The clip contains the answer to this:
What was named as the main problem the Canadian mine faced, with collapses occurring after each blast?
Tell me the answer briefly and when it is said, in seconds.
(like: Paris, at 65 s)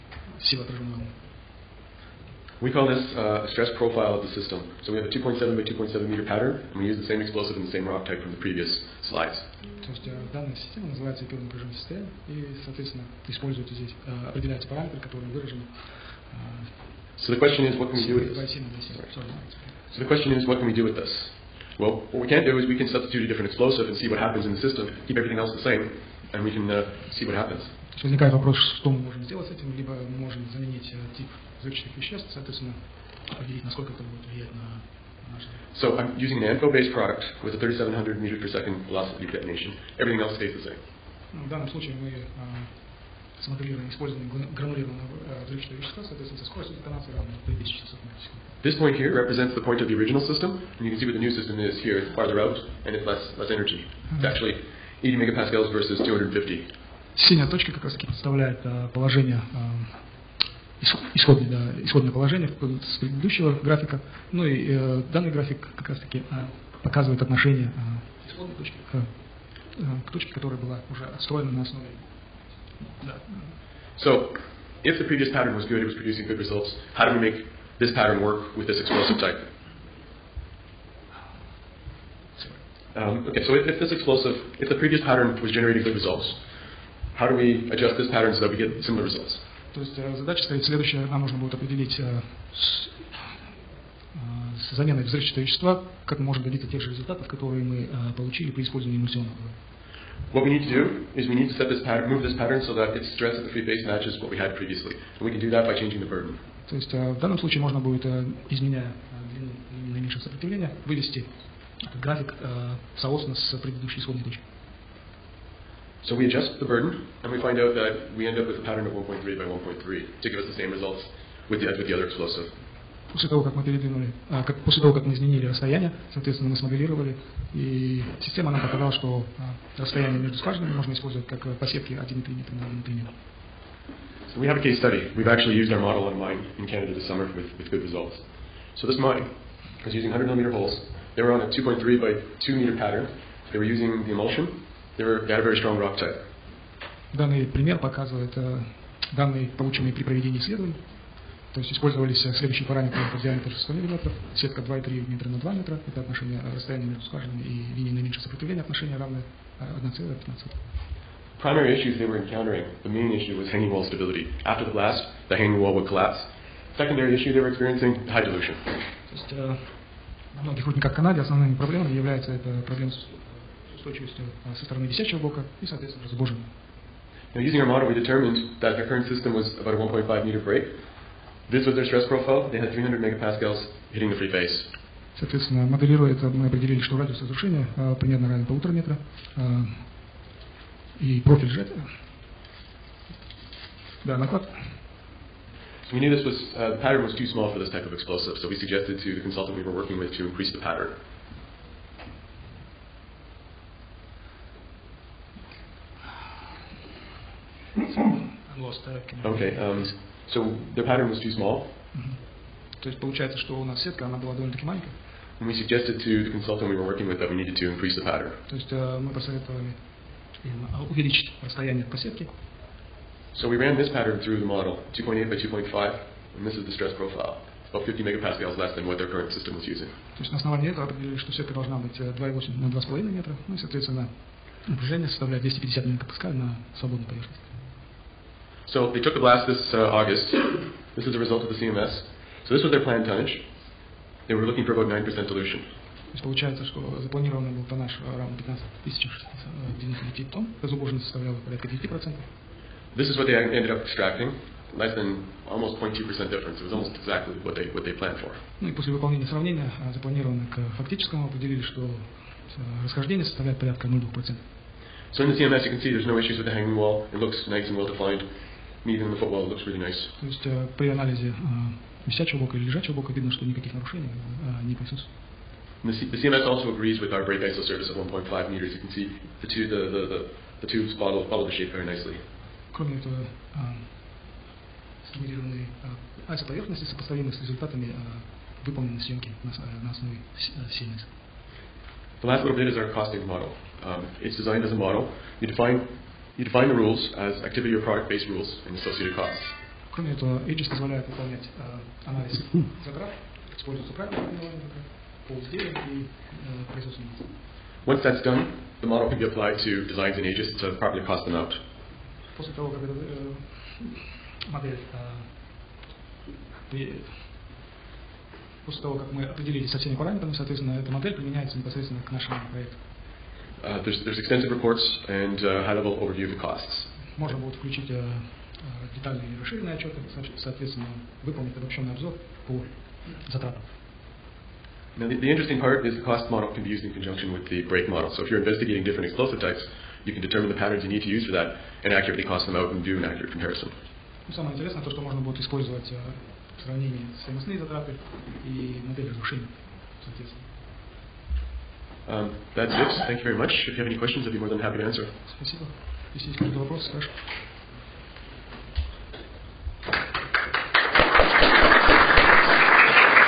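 Hanging wall stability, at 163 s.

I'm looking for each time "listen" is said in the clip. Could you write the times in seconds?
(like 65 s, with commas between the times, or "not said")
not said.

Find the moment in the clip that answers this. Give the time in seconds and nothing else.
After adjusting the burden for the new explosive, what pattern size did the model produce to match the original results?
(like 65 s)
118 s.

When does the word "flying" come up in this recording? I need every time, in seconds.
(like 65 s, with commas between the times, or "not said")
not said.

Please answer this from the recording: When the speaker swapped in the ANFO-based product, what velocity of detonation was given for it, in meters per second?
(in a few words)
3,700.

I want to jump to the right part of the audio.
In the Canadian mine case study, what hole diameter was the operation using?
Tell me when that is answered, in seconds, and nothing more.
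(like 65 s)
140 s.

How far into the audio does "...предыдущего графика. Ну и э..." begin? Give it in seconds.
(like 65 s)
62 s.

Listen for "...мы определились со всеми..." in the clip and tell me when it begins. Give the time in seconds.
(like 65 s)
319 s.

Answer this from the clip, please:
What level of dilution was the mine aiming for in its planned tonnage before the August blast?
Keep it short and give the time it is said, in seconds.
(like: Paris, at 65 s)
9%, at 244 s.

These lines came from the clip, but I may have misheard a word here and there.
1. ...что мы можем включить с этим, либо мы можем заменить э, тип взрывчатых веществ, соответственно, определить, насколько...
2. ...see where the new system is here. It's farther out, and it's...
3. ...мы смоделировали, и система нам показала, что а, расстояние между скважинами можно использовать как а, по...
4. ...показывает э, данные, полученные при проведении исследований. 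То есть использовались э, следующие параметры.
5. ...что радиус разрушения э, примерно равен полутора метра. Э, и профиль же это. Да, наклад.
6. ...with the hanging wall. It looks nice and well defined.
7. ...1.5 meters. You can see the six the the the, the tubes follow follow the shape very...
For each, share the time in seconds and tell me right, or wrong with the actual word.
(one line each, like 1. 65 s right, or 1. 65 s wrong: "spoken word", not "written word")
1. 28 s wrong: "сделать", not "включить"
2. 50 s right
3. 126 s right
4. 147 s right
5. 186 s right
6. 266 s right
7. 277 s wrong: "two", not "six".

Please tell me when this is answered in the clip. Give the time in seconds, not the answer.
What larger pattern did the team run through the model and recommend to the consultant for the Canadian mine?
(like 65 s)
224 s.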